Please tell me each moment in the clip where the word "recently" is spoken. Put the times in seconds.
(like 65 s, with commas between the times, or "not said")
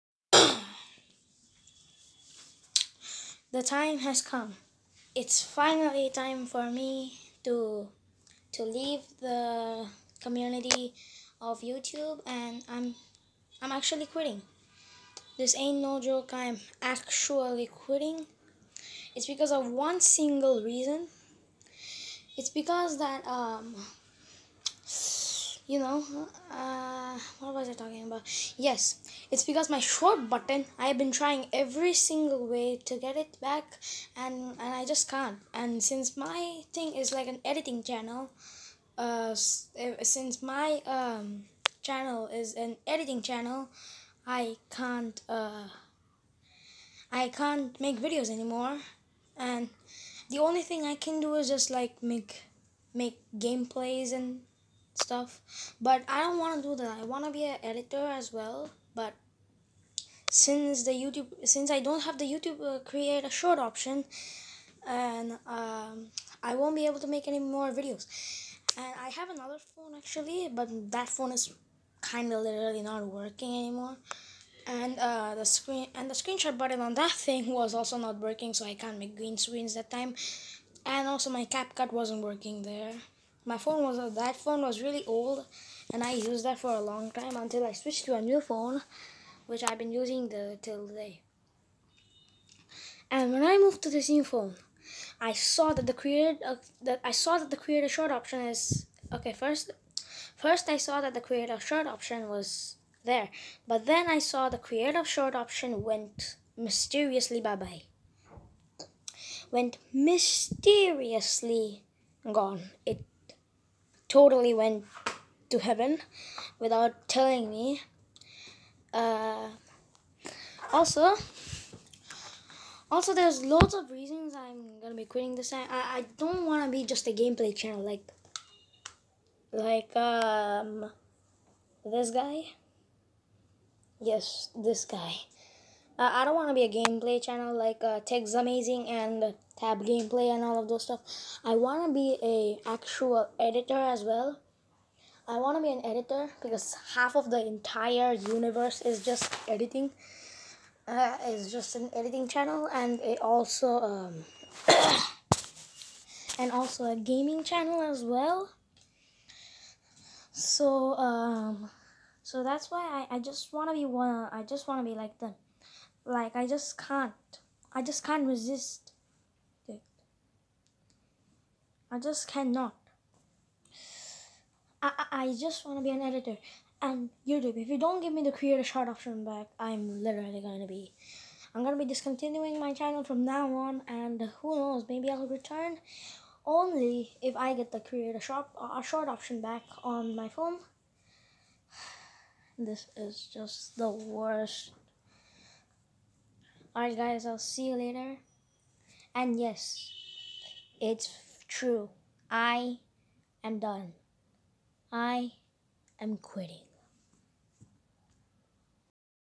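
not said.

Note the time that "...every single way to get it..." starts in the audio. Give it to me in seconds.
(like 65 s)
31 s.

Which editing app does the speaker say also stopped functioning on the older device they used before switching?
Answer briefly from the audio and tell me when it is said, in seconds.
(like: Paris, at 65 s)
CapCut, at 81 s.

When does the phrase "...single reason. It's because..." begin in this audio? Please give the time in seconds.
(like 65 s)
19 s.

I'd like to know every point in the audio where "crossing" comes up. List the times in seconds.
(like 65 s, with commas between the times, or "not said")
not said.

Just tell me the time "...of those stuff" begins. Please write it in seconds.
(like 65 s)
140 s.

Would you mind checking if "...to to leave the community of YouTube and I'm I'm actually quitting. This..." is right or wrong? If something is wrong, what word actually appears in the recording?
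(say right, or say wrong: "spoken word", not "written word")
right.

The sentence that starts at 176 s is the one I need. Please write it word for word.
And YouTube, if you don't give me the creator shot option back, I'm literally going to be...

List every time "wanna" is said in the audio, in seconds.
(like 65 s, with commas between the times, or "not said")
126 s.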